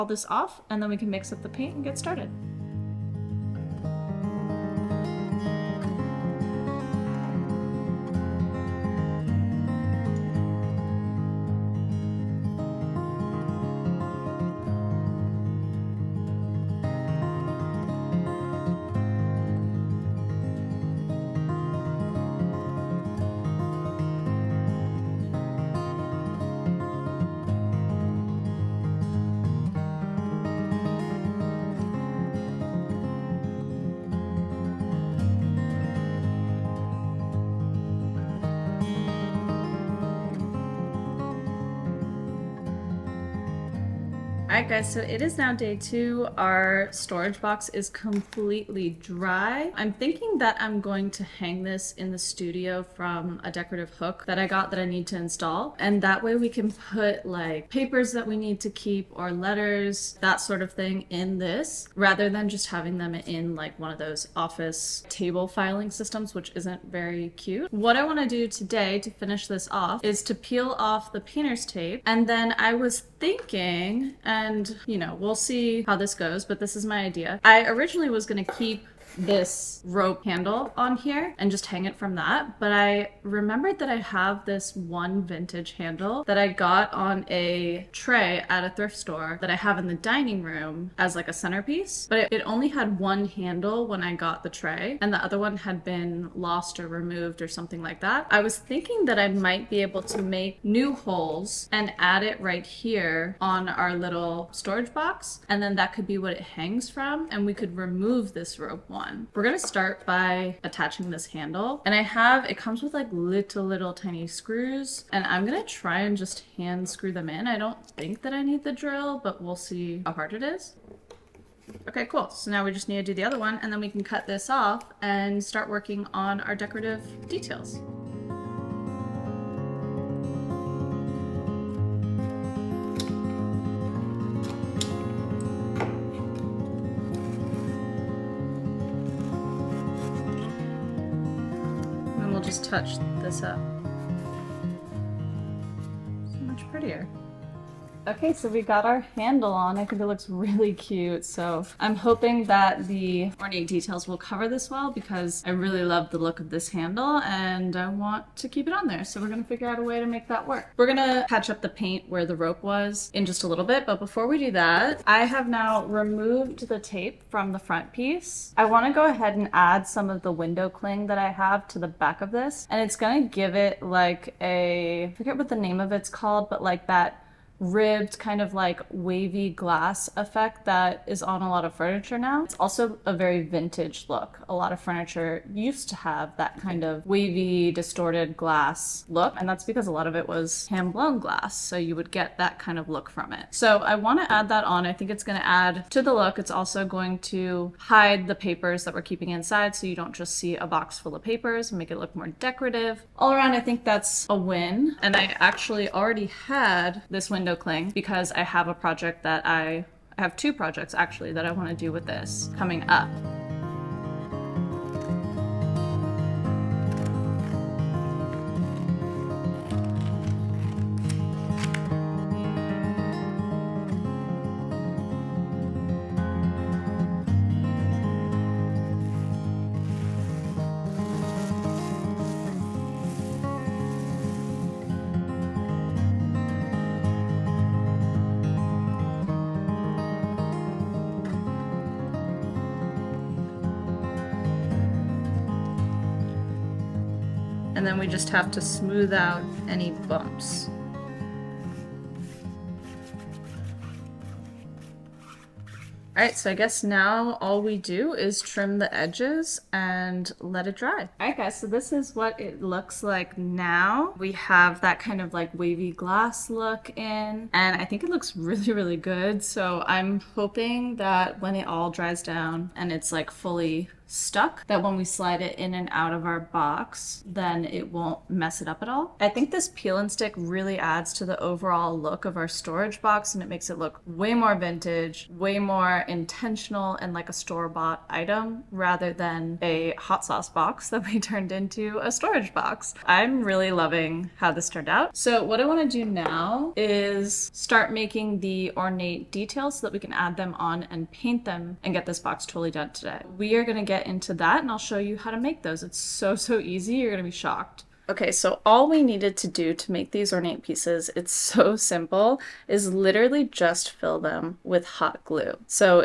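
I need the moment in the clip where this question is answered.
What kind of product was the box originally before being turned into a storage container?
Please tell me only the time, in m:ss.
4:49.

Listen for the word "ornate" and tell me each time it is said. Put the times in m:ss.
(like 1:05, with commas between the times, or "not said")
2:33, 4:58, 5:10.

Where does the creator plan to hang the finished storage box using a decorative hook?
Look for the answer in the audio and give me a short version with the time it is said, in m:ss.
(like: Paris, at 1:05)
The studio, at 0:52.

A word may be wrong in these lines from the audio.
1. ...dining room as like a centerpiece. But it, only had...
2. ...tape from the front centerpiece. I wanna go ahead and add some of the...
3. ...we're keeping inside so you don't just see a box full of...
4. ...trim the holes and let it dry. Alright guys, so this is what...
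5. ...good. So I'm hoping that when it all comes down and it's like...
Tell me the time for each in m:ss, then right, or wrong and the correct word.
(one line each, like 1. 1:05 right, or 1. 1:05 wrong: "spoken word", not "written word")
1. 1:29 right
2. 2:46 wrong: "piece", not "centerpiece"
3. 3:18 right
4. 4:18 wrong: "edges", not "holes"
5. 4:28 wrong: "dries", not "comes".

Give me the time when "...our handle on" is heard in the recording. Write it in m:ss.
2:28.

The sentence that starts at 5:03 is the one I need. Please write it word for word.
We are gonna get get into that and I'll show you how to make those.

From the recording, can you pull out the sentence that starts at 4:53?
I'm really loving how this turned out.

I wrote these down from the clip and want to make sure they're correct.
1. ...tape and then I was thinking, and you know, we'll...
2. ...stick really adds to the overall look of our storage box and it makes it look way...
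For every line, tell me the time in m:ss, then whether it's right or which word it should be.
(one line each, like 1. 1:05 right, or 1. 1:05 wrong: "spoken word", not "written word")
1. 1:11 right
2. 4:40 right.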